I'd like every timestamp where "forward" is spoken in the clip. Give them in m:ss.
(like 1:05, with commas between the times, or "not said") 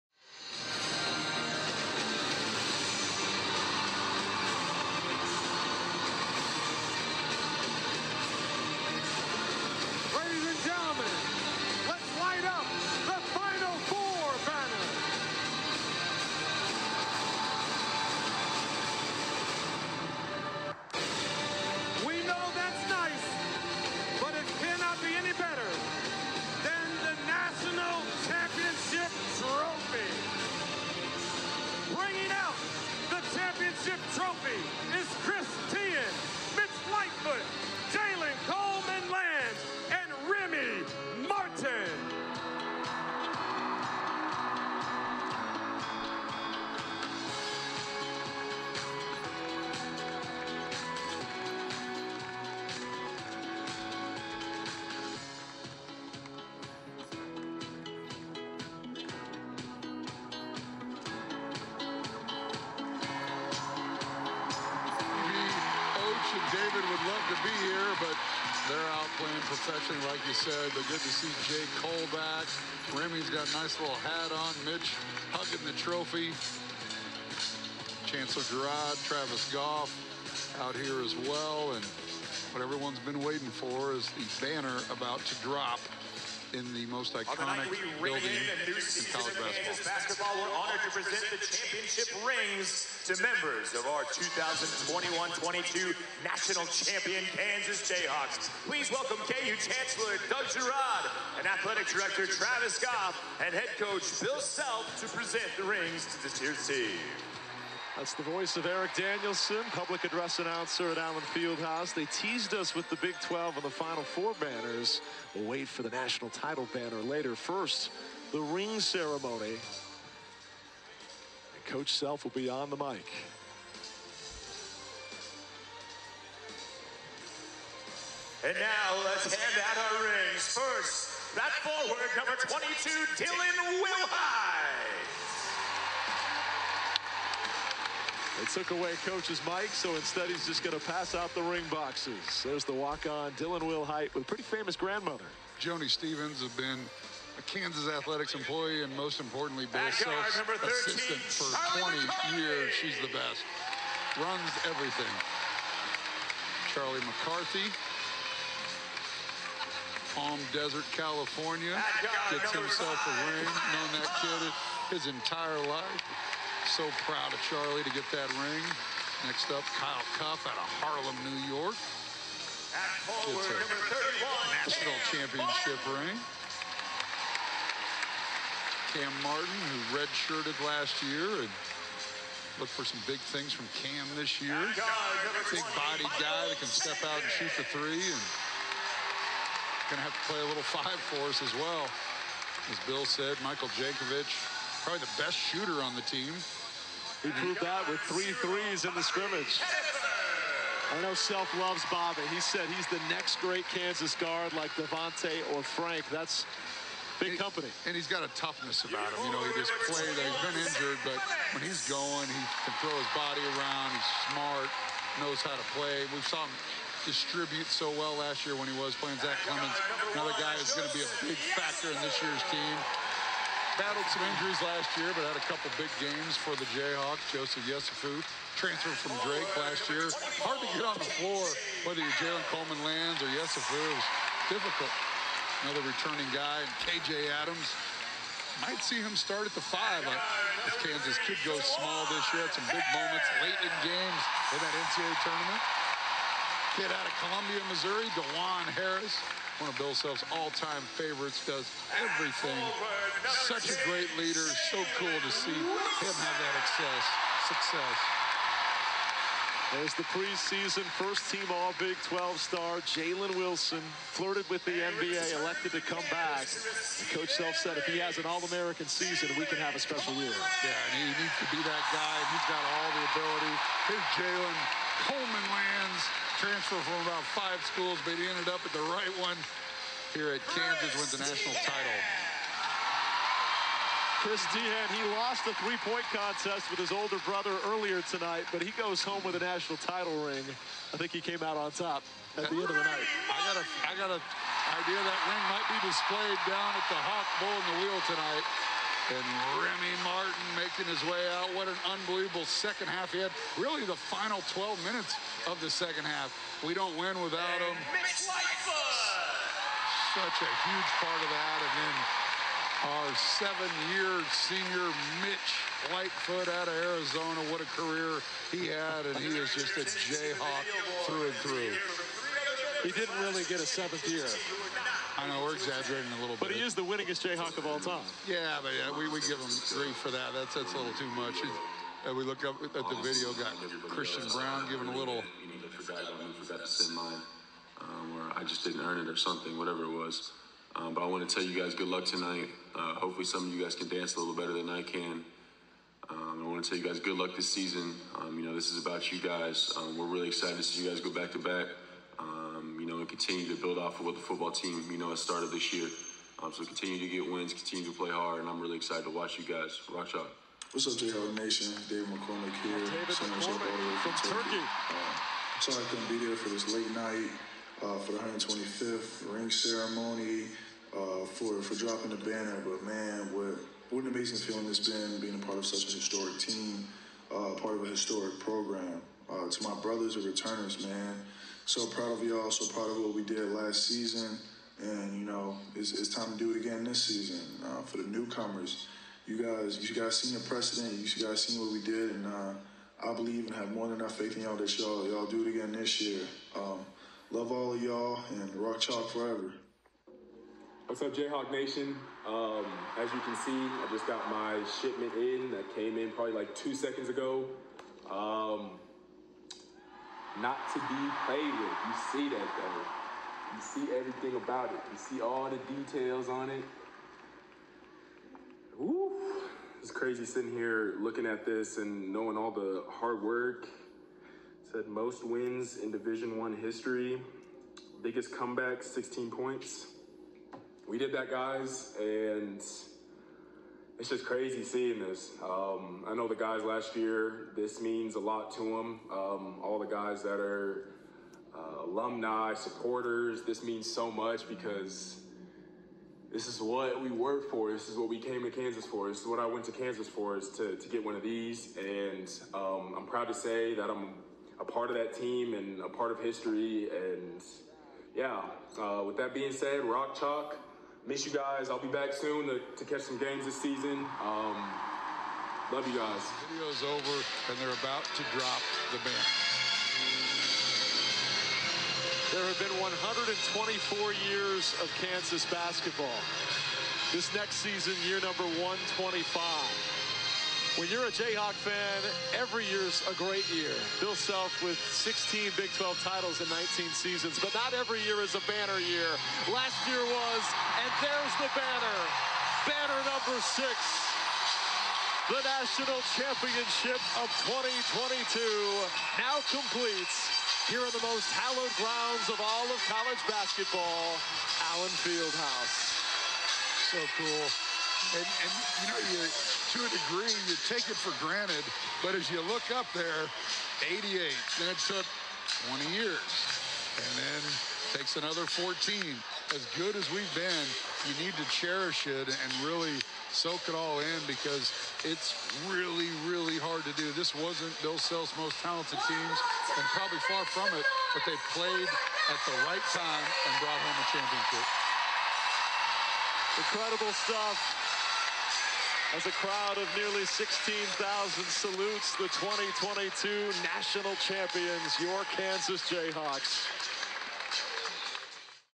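2:11.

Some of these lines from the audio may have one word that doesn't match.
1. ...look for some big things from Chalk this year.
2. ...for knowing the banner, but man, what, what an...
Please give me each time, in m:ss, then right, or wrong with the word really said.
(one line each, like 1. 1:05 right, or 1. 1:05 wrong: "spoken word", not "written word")
1. 3:02 wrong: "Cam", not "Chalk"
2. 6:11 wrong: "dropping", not "knowing".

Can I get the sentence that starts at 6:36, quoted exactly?
Um, love all of y'all and rock chalk forever.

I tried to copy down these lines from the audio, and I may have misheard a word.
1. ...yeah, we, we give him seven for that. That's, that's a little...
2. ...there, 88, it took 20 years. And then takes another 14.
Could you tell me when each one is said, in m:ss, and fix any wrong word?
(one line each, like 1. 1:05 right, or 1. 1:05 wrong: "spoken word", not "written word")
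1. 5:28 wrong: "three", not "seven"
2. 8:32 right.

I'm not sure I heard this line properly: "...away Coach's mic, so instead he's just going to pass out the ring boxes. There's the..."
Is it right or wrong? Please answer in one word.
right.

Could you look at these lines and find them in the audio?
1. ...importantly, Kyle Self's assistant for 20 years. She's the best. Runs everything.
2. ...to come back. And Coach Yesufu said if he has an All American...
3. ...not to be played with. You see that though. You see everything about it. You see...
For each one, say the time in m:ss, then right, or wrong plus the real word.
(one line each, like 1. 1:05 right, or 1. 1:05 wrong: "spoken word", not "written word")
1. 2:29 wrong: "Bill", not "Kyle"
2. 4:25 wrong: "Self", not "Yesufu"
3. 6:50 right.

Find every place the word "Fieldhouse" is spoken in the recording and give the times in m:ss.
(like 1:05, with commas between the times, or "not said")
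1:51, 8:25.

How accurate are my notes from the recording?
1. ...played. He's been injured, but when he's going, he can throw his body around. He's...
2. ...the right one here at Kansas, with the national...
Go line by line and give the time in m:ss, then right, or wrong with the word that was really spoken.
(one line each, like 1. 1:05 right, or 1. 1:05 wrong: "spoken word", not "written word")
1. 3:29 right
2. 4:38 right.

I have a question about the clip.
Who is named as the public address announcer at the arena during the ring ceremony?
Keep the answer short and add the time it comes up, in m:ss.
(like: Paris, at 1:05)
Eric Danielson, at 1:48.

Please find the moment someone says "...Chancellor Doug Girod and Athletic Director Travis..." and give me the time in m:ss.
1:39.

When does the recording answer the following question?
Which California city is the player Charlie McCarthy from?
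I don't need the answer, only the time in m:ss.
2:40.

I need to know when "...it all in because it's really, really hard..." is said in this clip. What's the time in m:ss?
8:43.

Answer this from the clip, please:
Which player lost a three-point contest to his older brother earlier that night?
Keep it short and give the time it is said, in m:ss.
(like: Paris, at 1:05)
Chris Teahan, at 4:44.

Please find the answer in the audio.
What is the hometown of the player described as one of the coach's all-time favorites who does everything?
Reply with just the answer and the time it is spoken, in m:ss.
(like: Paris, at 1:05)
Columbia, Missouri, at 4:07.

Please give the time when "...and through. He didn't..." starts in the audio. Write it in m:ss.
5:21.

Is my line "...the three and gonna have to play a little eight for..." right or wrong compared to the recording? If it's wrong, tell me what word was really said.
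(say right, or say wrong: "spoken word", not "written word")
wrong: "five", not "eight".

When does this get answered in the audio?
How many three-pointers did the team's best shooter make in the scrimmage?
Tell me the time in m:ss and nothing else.
3:18.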